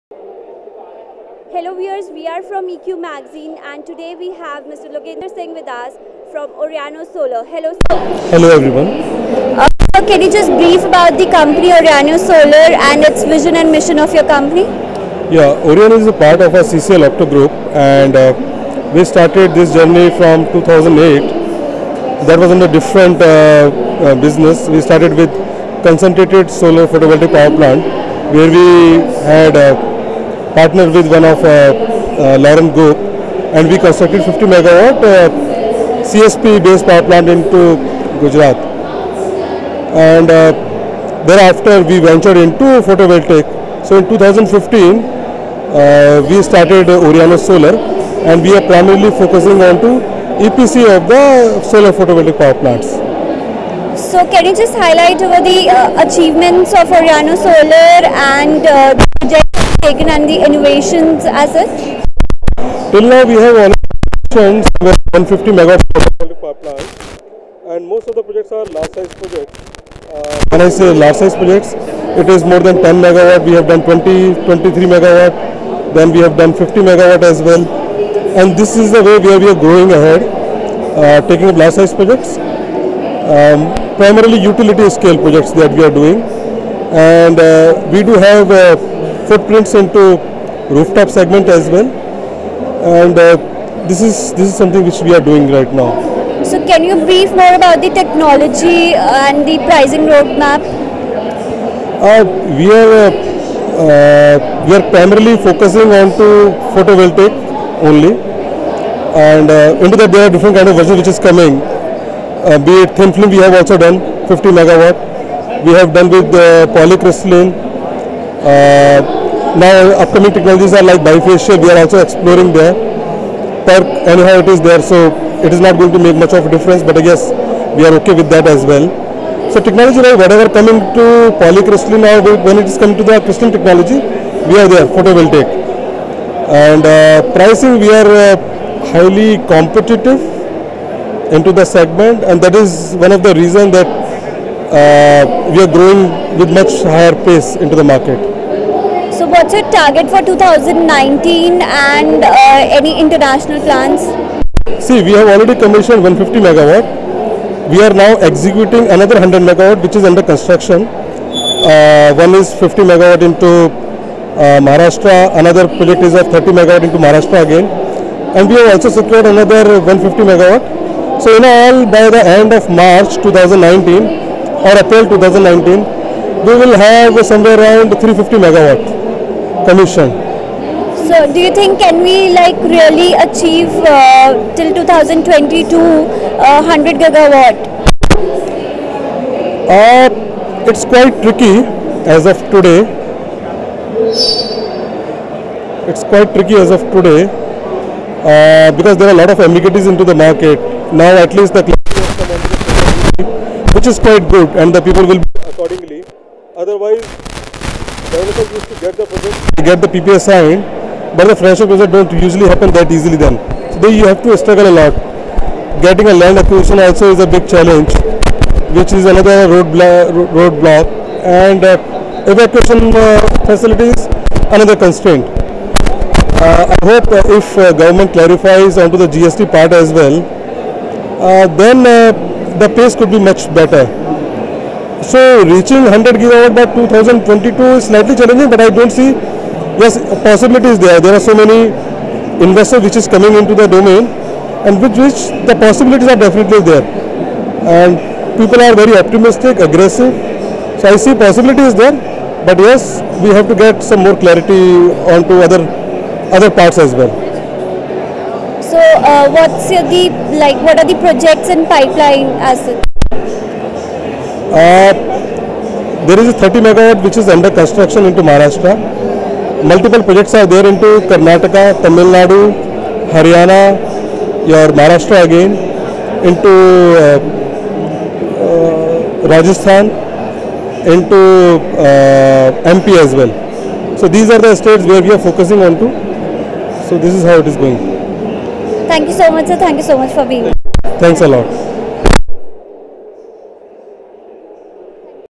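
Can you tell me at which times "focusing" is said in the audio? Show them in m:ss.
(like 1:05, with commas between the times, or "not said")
0:49, 1:45, 4:45.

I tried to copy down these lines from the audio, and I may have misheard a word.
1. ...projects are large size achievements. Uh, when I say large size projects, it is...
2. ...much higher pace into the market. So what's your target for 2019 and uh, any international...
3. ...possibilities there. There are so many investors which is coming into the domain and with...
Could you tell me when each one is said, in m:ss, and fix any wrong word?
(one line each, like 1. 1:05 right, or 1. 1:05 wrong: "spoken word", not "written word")
1. 1:08 wrong: "projects", not "achievements"
2. 2:26 right
3. 4:00 right.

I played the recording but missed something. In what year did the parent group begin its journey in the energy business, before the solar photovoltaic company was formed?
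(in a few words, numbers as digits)
2008.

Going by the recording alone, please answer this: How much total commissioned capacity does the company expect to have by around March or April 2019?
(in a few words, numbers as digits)
350 megawatt.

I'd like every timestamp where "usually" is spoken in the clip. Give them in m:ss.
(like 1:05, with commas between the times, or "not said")
3:32.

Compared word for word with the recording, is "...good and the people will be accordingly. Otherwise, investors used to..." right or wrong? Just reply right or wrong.
wrong.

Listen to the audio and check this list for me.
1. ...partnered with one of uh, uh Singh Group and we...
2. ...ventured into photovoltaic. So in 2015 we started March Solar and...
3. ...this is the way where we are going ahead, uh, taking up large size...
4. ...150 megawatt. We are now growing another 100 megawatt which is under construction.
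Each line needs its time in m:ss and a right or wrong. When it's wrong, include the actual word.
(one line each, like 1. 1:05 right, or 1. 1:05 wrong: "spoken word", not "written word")
1. 0:30 wrong: "Laram", not "Singh"
2. 0:41 wrong: "Oriano", not "March"
3. 1:18 right
4. 2:36 wrong: "executing", not "growing".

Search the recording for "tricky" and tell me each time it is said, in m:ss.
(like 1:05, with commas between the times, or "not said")
3:11, 3:16.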